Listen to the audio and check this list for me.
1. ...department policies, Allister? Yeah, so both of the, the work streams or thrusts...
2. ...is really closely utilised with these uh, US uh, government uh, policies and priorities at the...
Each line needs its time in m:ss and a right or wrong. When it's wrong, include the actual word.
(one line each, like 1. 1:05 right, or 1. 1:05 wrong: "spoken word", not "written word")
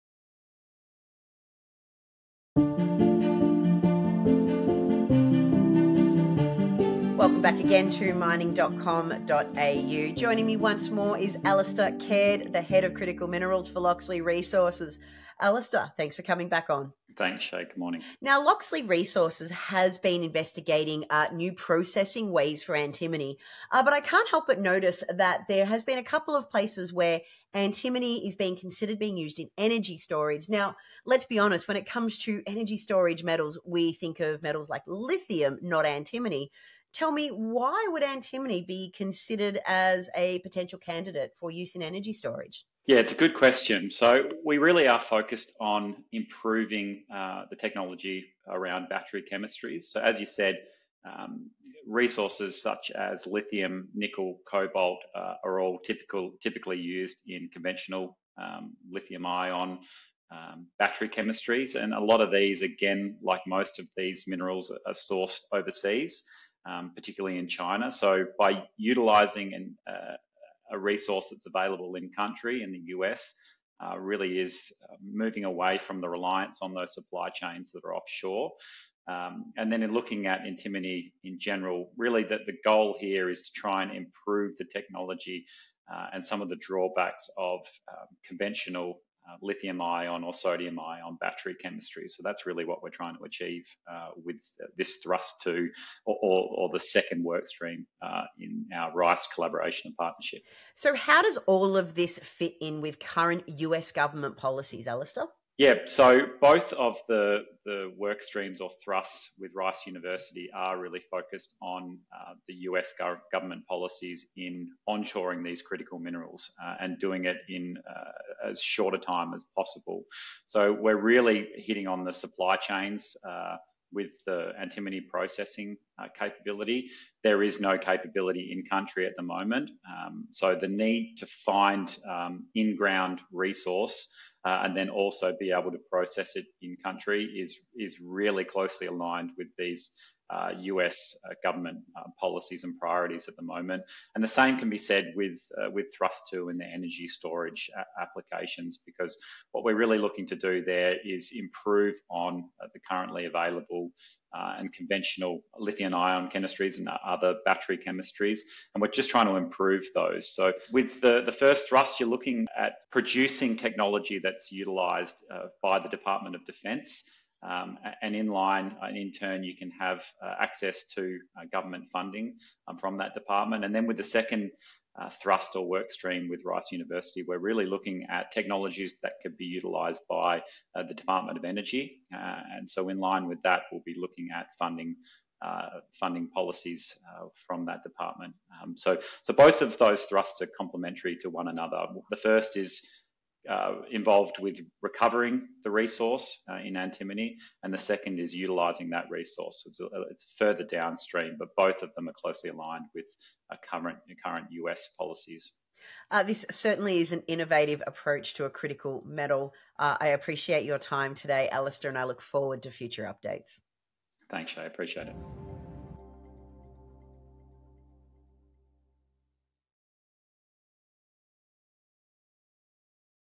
1. 1:43 wrong: "government", not "department"
2. 2:17 wrong: "aligned", not "utilised".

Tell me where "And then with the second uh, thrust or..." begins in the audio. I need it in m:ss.
2:53.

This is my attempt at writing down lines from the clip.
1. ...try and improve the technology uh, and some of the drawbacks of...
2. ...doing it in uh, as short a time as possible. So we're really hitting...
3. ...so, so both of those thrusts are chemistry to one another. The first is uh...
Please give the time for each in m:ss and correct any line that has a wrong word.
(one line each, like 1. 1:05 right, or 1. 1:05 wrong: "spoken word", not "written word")
1. 1:23 right
2. 1:56 right
3. 3:08 wrong: "complementary", not "chemistry".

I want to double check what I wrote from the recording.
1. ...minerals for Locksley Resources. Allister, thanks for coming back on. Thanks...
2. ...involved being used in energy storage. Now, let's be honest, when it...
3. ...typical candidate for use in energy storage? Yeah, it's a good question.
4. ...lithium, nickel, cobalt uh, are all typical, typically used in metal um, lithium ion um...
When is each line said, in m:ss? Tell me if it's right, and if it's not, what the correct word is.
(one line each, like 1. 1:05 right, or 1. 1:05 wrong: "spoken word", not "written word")
1. 0:13 right
2. 0:28 wrong: "considered", not "involved"
3. 0:40 wrong: "potential", not "typical"
4. 0:53 wrong: "conventional", not "metal".